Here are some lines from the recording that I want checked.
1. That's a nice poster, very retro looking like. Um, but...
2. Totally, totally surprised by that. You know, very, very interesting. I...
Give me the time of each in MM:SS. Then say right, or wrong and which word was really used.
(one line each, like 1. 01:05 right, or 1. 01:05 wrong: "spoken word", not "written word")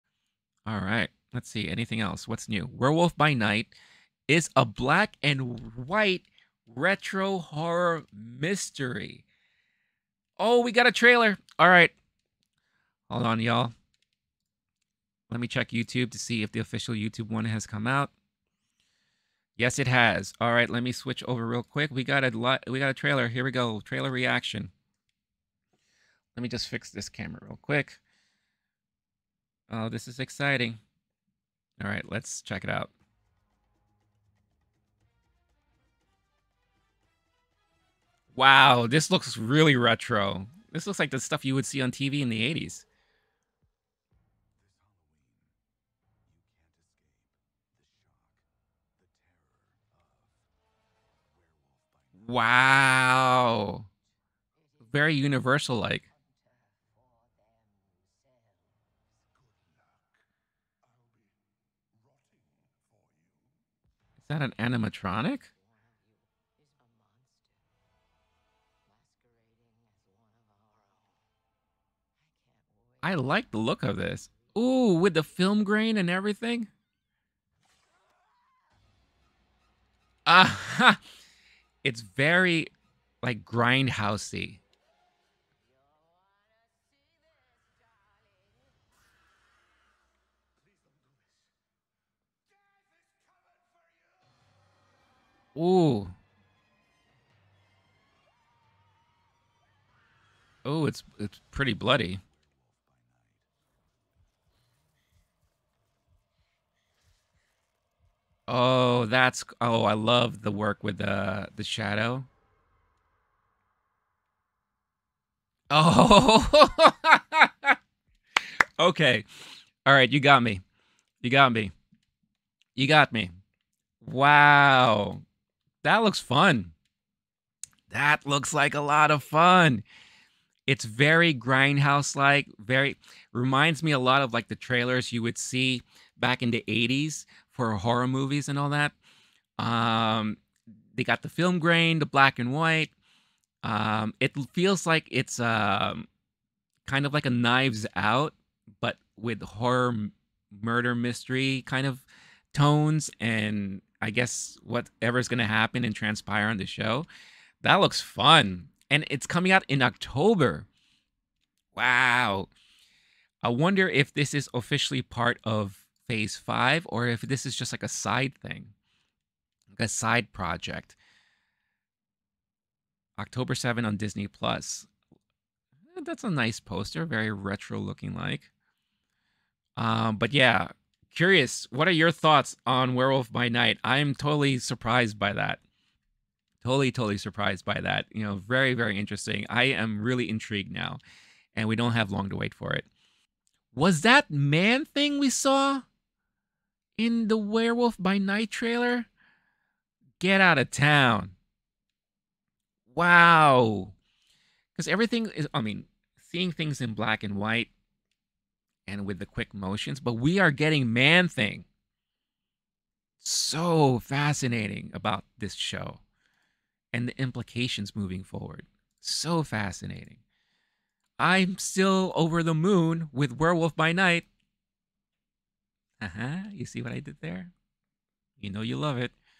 1. 02:56 right
2. 03:06 right.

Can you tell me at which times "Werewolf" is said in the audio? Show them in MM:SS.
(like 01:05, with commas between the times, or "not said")
00:02, 03:02, 03:17, 03:43.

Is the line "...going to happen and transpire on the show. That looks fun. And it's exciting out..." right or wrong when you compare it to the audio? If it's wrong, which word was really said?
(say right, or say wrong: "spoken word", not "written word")
wrong: "coming", not "exciting".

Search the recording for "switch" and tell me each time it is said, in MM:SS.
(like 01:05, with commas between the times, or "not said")
00:20.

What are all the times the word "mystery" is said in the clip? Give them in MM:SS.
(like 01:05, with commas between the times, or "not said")
00:08, 02:30.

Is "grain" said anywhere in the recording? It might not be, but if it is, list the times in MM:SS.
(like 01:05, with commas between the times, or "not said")
01:15, 02:21.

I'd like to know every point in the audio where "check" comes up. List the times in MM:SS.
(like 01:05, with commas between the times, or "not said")
00:15, 00:32.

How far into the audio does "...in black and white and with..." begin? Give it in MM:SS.
03:26.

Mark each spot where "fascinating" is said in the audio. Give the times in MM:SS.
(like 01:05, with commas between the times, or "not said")
03:33, 03:39.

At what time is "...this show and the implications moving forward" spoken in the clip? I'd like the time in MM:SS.
03:35.